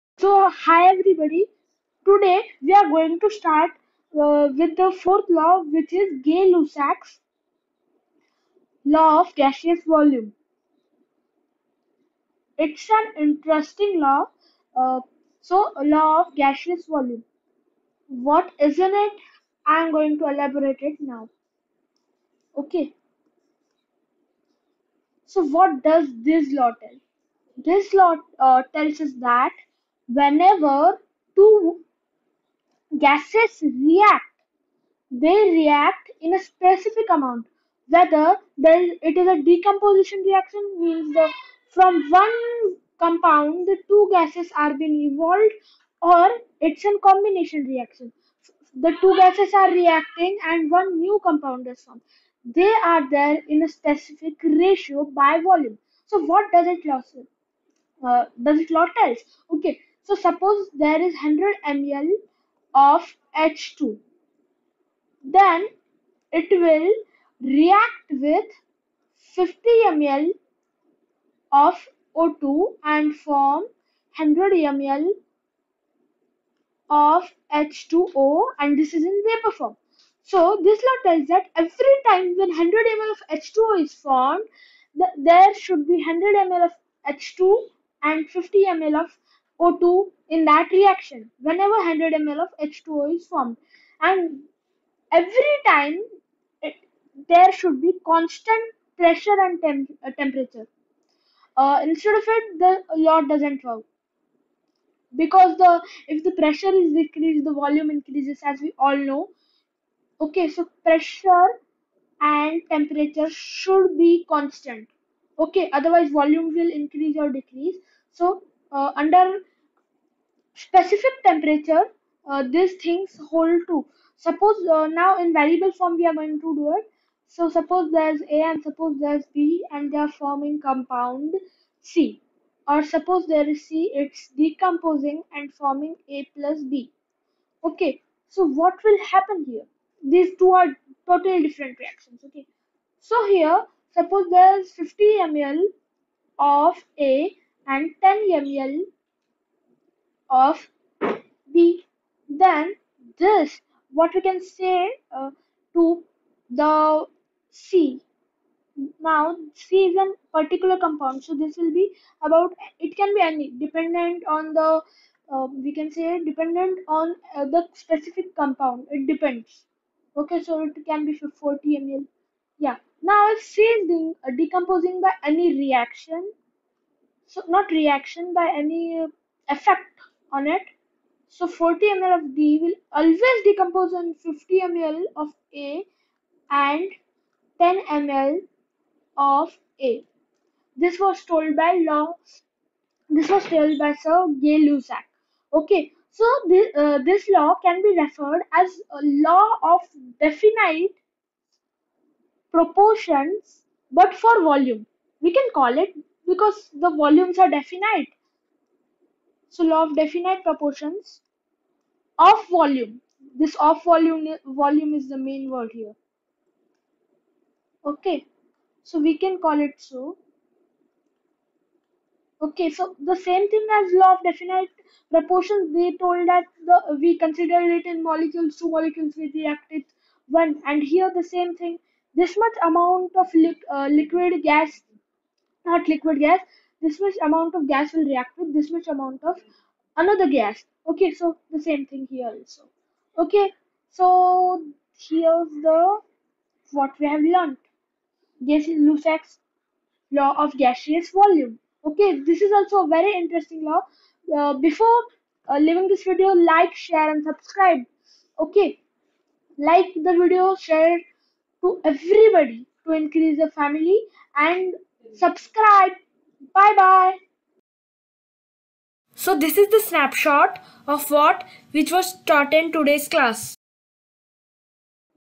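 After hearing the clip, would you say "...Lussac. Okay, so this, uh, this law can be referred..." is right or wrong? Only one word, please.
right.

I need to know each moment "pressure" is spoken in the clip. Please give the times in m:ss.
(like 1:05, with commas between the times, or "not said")
1:38, 1:46, 1:50.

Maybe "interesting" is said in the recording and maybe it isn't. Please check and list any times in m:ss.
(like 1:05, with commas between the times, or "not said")
0:13, 4:13.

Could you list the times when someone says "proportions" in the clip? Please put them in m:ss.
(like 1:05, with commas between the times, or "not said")
3:22, 3:30, 3:45.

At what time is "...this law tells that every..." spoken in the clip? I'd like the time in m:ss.
1:20.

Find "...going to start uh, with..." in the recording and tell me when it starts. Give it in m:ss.
0:02.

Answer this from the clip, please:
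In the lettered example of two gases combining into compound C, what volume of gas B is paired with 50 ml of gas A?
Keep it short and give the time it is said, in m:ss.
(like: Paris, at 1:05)
10 ml, at 2:28.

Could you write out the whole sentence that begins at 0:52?
They are there in a specific ratio by volume.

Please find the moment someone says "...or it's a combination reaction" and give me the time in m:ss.
0:46.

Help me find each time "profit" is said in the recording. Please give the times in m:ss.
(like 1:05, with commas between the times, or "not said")
not said.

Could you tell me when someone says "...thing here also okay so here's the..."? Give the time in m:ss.
4:01.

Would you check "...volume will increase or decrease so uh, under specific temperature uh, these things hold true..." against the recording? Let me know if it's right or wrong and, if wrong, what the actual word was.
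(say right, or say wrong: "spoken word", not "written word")
right.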